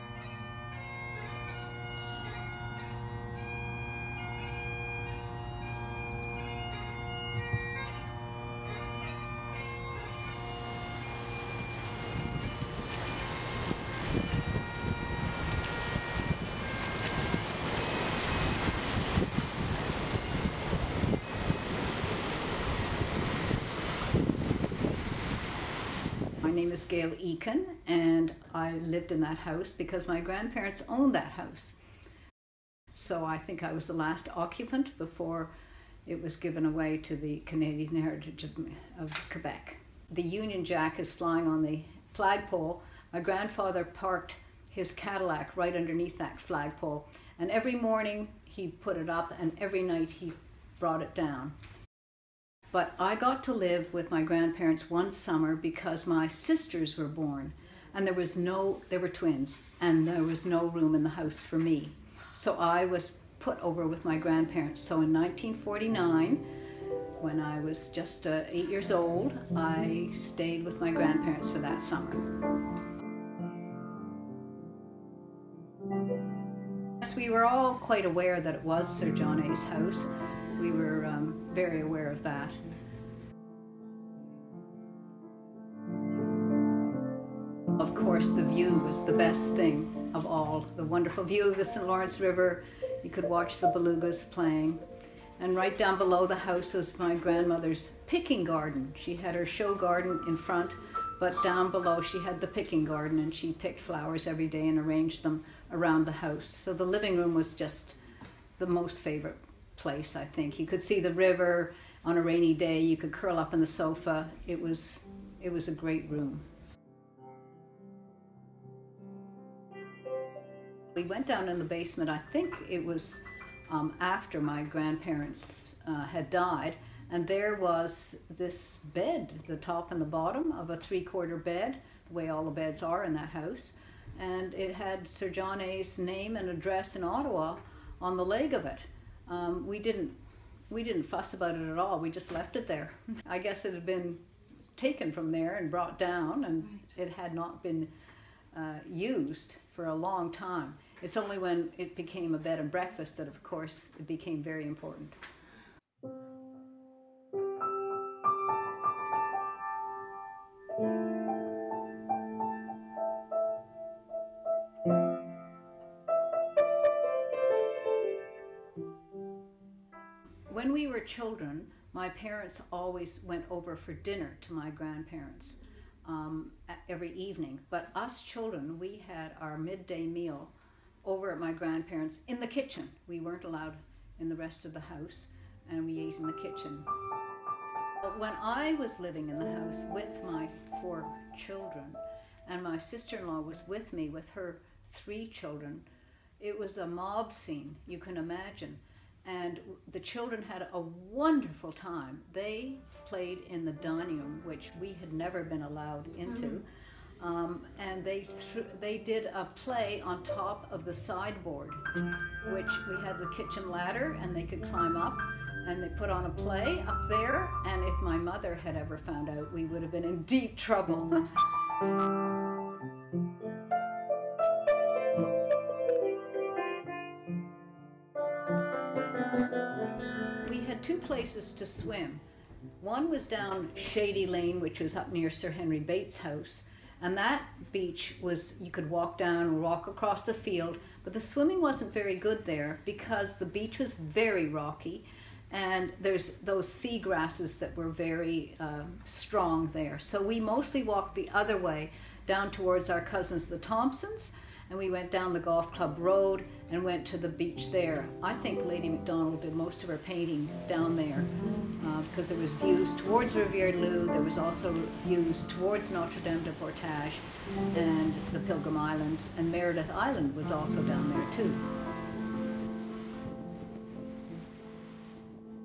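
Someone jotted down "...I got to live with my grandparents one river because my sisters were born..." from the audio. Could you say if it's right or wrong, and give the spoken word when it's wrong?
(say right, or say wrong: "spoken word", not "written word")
wrong: "summer", not "river".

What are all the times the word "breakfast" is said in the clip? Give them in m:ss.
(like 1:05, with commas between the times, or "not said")
2:32.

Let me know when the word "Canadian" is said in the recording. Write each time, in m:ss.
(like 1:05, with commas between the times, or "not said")
0:37.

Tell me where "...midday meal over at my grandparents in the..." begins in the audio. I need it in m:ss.
2:59.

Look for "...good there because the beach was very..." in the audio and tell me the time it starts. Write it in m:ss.
4:02.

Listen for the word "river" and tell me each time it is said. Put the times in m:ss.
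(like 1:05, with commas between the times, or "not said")
1:32, 1:51.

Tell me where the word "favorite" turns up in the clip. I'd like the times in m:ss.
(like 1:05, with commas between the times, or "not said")
1:48.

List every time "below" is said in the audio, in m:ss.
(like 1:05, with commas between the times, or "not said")
1:35, 1:41.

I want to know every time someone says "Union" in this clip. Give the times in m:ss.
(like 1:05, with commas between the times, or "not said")
0:40.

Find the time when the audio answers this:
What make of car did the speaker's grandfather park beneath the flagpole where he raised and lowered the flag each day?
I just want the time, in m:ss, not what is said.
0:44.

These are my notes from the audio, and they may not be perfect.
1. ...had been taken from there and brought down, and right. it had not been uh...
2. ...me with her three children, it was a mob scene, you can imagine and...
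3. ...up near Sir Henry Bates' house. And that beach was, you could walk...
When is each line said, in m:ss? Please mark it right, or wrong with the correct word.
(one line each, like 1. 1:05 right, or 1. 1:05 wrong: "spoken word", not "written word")
1. 2:23 right
2. 3:13 right
3. 3:54 right.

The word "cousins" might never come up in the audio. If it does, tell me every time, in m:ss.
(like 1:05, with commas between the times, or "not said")
4:12.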